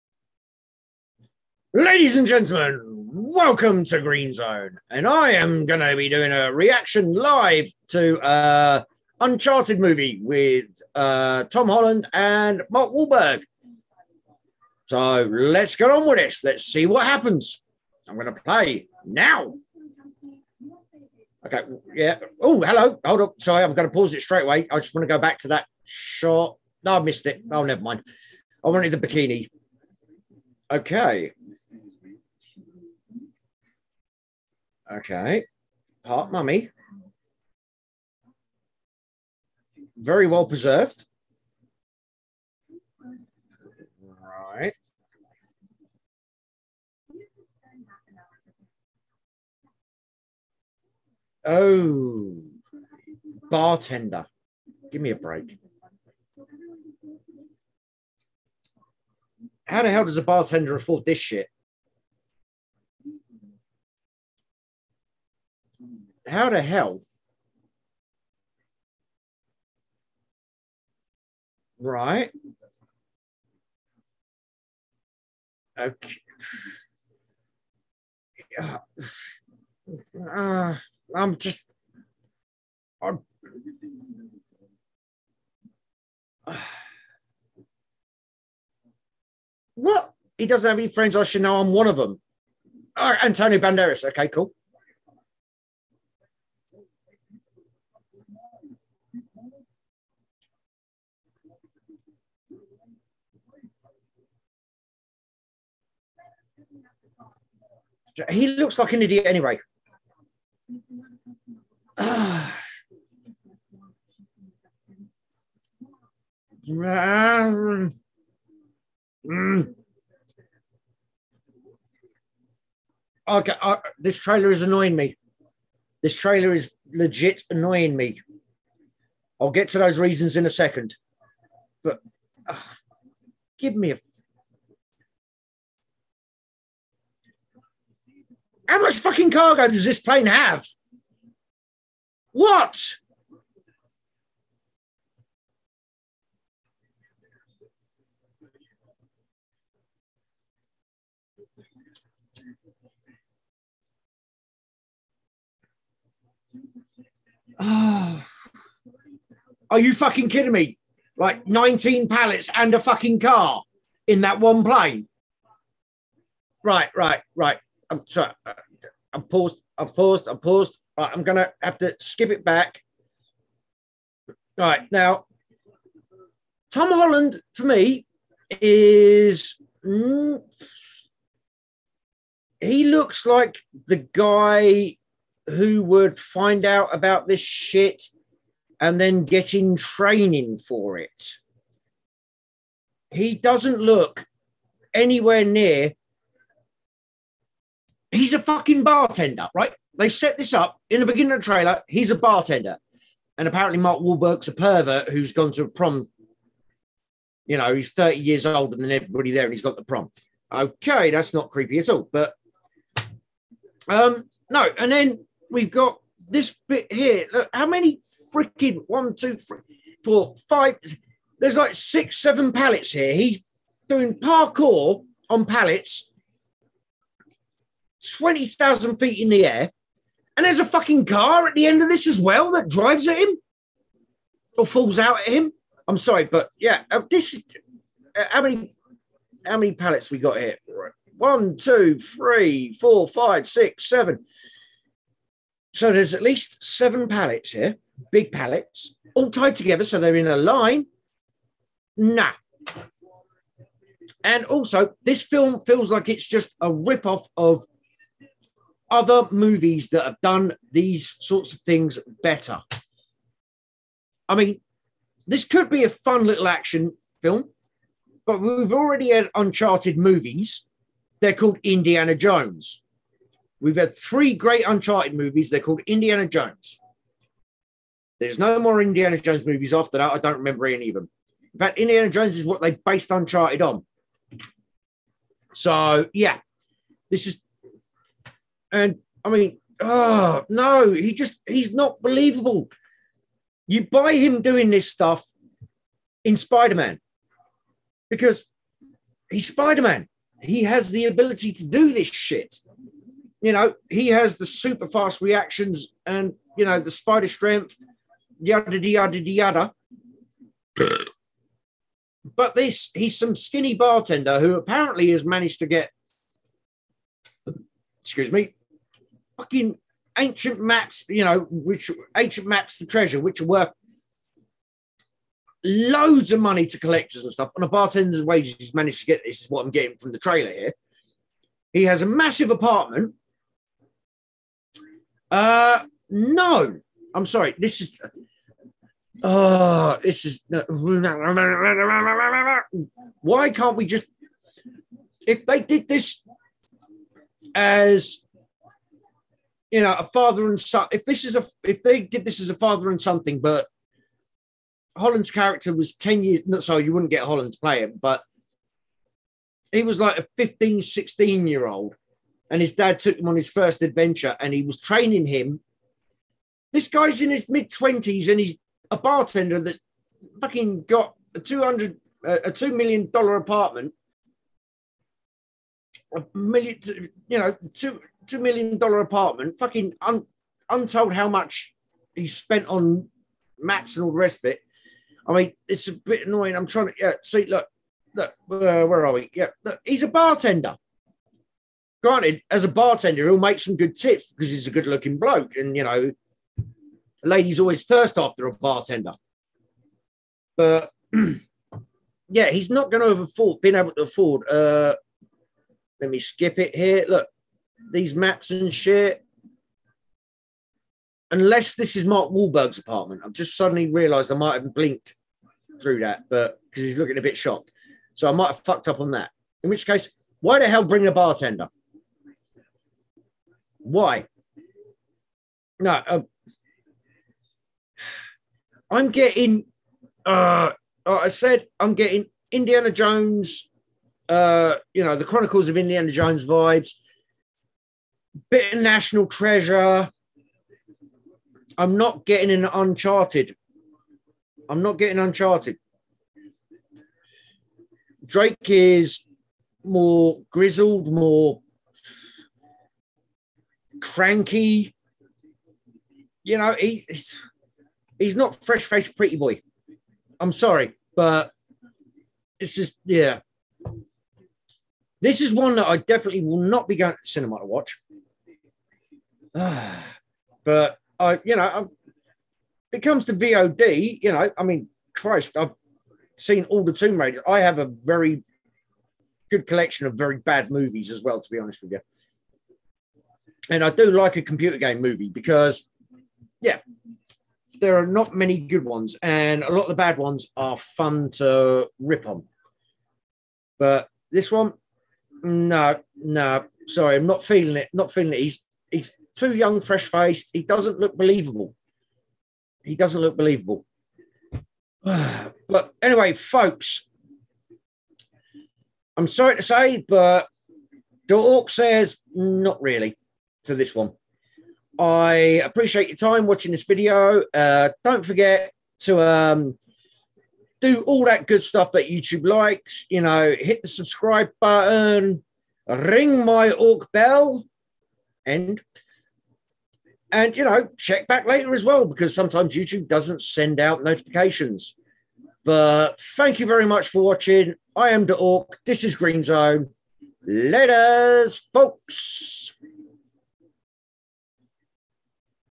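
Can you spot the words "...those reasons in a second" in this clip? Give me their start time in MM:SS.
02:09.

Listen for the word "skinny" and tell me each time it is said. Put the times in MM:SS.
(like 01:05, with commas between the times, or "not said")
05:13.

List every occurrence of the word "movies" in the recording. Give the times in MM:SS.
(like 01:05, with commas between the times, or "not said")
00:09, 04:19, 04:29, 04:35, 04:39, 08:00, 08:05.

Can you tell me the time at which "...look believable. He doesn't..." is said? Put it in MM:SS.
08:20.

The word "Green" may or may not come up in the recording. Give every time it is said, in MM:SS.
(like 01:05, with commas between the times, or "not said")
00:04, 08:59.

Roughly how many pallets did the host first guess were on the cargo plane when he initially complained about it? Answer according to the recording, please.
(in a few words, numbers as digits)
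19.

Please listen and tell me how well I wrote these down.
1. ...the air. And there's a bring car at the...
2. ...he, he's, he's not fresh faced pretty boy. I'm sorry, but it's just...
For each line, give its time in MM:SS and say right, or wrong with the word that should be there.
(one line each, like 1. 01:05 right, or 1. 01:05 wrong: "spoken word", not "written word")
1. 03:49 wrong: "fucking", not "bring"
2. 07:36 right.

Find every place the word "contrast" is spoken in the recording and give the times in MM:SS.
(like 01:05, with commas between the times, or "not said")
not said.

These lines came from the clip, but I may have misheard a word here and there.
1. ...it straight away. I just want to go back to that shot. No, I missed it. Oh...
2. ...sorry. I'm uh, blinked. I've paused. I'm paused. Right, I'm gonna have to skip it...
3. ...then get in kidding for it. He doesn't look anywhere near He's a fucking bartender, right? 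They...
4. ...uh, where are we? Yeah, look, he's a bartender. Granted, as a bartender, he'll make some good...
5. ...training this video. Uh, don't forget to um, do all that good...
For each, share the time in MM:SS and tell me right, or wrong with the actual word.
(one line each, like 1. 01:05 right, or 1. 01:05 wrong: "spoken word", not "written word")
1. 00:24 right
2. 02:48 wrong: "paused", not "blinked"
3. 03:09 wrong: "training", not "kidding"
4. 06:28 right
5. 08:36 wrong: "watching", not "training".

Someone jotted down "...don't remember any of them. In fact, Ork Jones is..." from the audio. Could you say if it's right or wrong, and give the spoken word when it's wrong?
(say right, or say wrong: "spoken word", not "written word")
wrong: "Indiana", not "Ork".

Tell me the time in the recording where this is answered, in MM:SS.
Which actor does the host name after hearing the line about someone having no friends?
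01:33.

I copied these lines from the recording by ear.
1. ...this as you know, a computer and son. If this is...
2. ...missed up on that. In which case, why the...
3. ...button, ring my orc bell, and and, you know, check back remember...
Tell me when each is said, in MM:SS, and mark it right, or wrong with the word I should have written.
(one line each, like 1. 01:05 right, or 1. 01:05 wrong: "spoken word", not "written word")
1. 05:45 wrong: "father", not "computer"
2. 06:58 wrong: "fucked", not "missed"
3. 08:44 wrong: "later", not "remember".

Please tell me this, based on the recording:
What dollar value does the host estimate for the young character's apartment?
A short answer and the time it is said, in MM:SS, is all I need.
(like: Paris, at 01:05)
$2 million, at 06:12.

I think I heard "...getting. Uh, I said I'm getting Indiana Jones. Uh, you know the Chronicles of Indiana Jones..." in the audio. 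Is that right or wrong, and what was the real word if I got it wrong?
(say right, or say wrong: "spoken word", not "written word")
right.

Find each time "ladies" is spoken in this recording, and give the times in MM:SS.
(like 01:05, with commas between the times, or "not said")
00:01, 06:37.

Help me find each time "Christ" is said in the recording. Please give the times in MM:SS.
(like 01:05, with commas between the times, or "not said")
07:55.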